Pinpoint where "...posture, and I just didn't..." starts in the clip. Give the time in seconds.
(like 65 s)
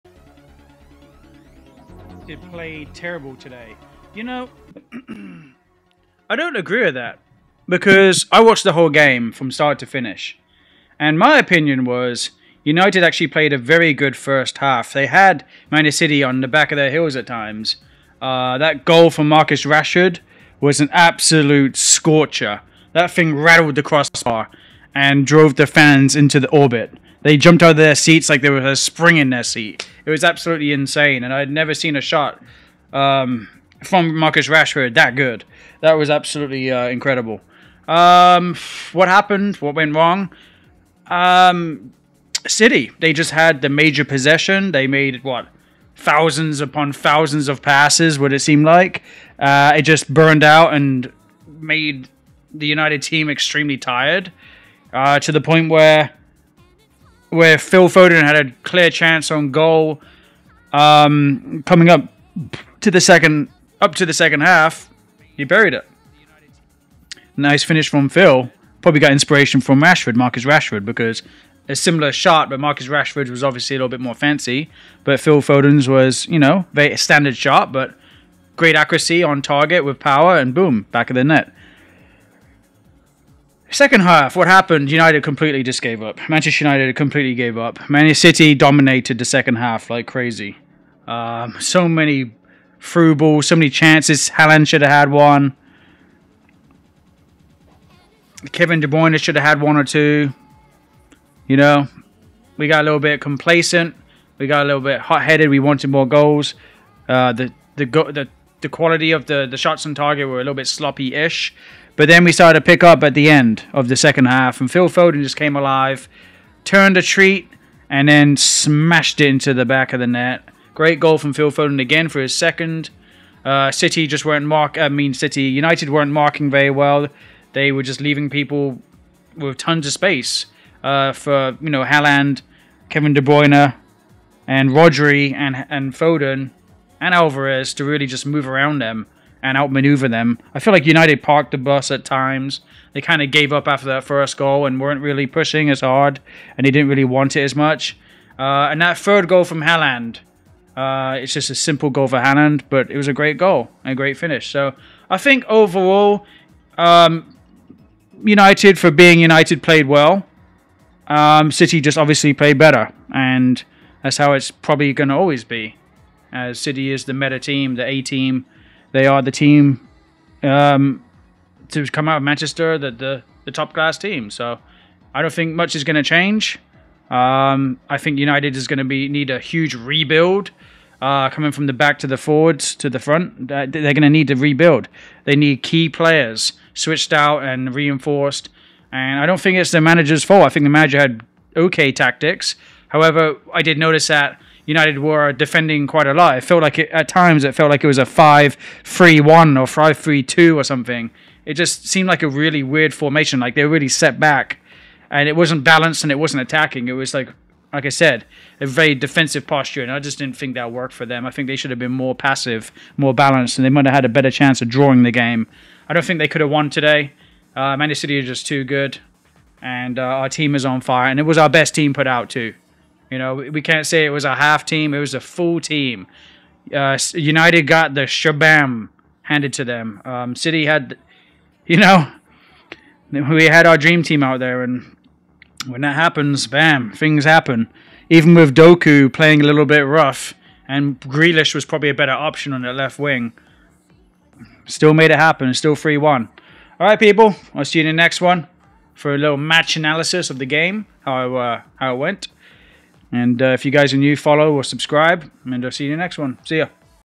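209 s.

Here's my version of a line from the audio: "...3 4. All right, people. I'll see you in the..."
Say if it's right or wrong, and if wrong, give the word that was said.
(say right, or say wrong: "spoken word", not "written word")
wrong: "1", not "4".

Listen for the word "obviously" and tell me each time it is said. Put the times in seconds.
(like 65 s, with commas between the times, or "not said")
73 s, 161 s.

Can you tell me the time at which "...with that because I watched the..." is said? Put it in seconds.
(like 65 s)
6 s.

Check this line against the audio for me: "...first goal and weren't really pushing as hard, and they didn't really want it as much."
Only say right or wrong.
right.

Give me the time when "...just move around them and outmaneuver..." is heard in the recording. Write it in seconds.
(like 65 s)
138 s.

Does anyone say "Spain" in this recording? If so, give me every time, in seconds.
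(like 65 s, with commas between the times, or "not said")
not said.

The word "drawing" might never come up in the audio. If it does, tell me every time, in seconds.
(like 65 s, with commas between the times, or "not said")
214 s.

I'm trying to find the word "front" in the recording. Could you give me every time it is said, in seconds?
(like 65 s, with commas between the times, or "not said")
182 s.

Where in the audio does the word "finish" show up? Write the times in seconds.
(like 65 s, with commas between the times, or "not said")
9 s, 67 s, 154 s.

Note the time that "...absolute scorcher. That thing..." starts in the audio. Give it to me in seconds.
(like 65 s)
20 s.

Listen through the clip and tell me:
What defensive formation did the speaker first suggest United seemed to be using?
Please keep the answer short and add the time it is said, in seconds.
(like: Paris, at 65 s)
5-3-1, at 198 s.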